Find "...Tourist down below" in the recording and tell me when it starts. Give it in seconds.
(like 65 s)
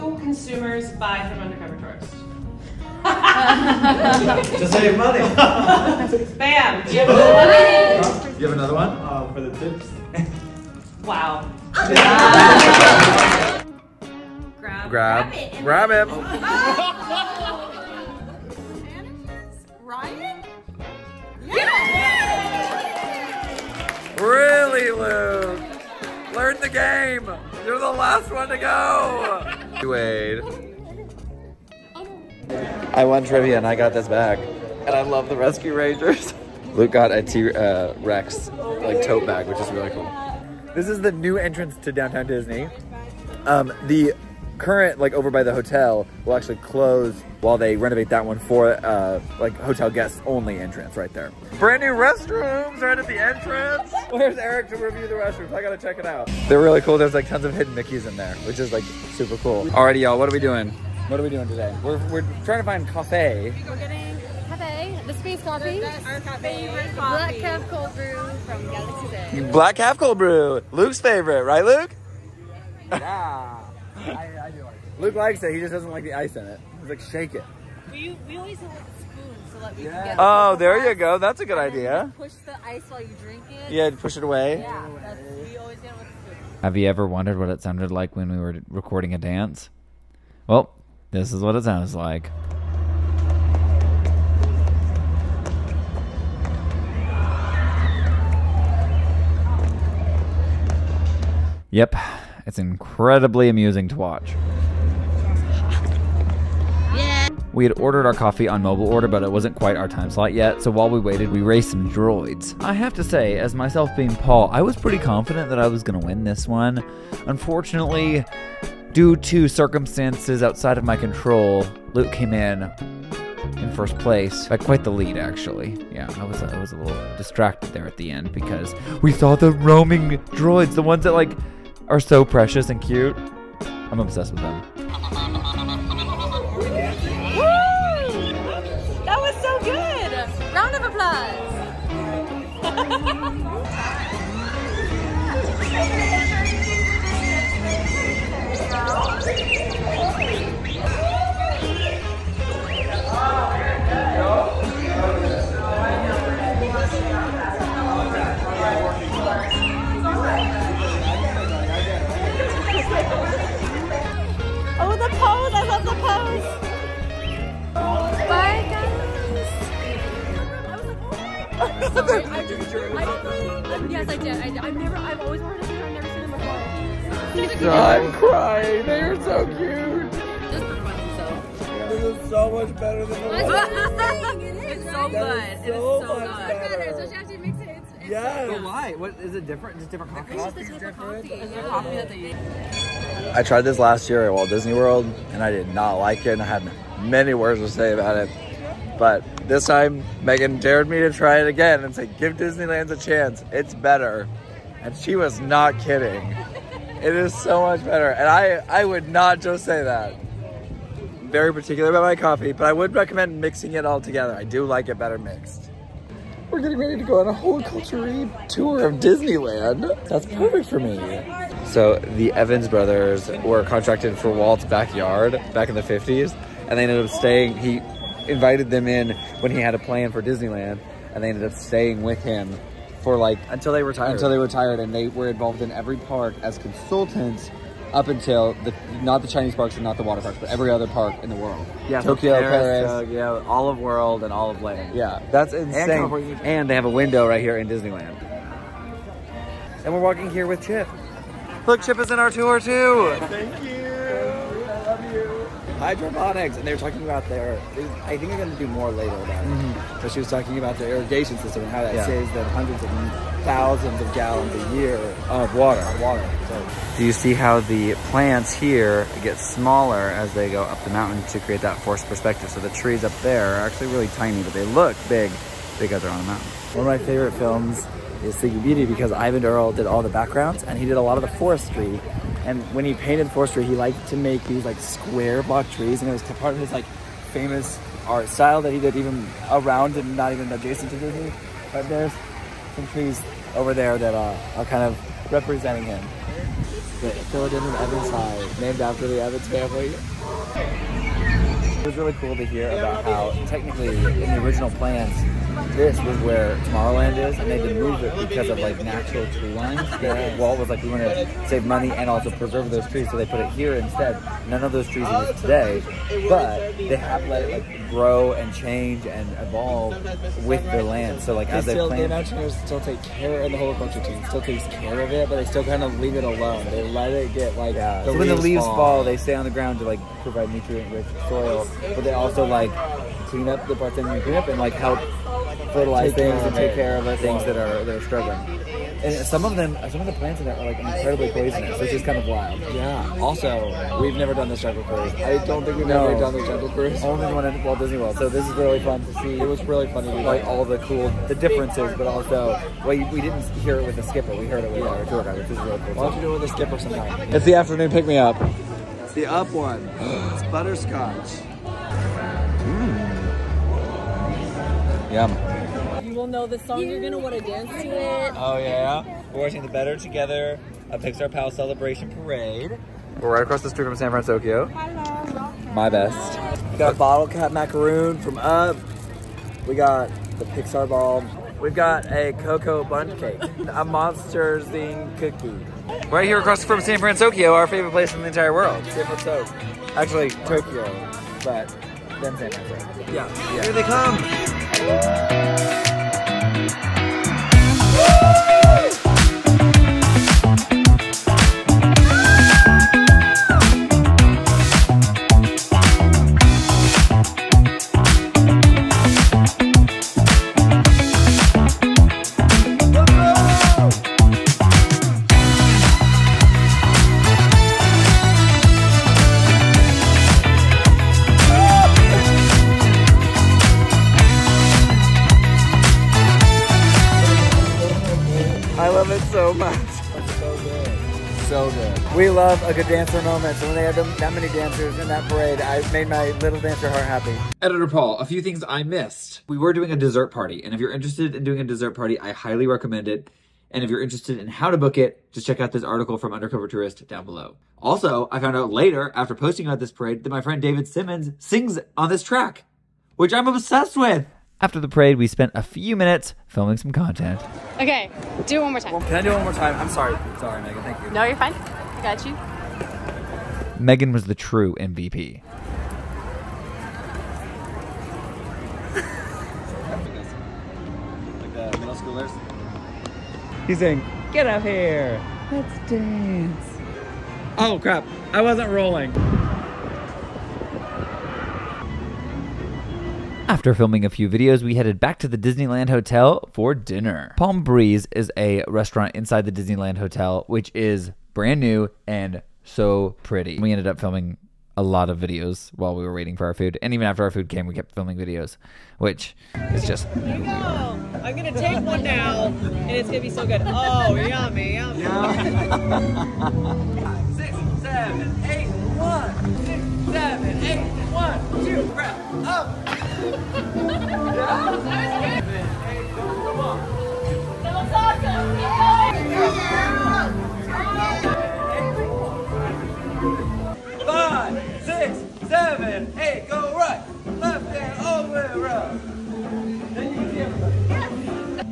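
446 s.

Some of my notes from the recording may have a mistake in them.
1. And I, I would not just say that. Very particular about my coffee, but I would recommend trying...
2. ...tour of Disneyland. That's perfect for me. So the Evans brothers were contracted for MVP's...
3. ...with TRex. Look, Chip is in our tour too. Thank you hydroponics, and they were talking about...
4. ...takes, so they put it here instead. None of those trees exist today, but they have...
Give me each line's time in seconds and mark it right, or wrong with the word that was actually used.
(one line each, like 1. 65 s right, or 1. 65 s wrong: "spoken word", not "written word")
1. 208 s wrong: "mixing", not "trying"
2. 218 s wrong: "Walt", not "MVP"
3. 250 s wrong: "Chip", not "TRex"
4. 312 s wrong: "trees", not "takes".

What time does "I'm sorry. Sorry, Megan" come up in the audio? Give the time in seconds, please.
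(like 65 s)
459 s.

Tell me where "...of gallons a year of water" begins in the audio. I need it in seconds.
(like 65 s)
264 s.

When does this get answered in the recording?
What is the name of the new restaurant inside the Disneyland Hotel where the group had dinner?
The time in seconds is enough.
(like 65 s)
487 s.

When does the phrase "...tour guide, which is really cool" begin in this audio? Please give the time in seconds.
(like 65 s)
355 s.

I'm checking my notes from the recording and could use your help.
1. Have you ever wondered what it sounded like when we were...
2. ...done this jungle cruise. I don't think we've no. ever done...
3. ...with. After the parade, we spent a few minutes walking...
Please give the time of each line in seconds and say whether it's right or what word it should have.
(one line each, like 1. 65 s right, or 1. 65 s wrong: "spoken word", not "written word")
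1. 86 s right
2. 344 s right
3. 453 s wrong: "filming", not "walking".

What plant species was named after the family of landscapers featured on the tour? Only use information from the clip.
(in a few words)
Philodendron evansii.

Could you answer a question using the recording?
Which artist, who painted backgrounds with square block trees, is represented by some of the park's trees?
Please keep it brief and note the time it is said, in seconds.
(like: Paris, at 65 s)
Eyvind Earle, at 279 s.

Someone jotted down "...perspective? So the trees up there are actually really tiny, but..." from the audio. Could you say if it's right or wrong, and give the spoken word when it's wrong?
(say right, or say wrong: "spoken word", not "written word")
right.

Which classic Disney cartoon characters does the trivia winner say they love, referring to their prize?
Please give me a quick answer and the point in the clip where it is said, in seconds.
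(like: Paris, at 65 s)
Rescue Rangers, at 35 s.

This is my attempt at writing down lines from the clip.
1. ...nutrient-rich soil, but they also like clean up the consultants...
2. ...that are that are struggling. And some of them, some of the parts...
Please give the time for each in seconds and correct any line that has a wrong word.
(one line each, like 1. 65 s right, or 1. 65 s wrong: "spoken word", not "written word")
1. 330 s wrong: "parts", not "consultants"
2. 337 s wrong: "plants", not "parts".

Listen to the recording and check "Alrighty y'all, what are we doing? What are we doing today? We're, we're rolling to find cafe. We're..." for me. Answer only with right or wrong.
wrong.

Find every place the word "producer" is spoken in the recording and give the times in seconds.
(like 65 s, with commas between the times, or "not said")
not said.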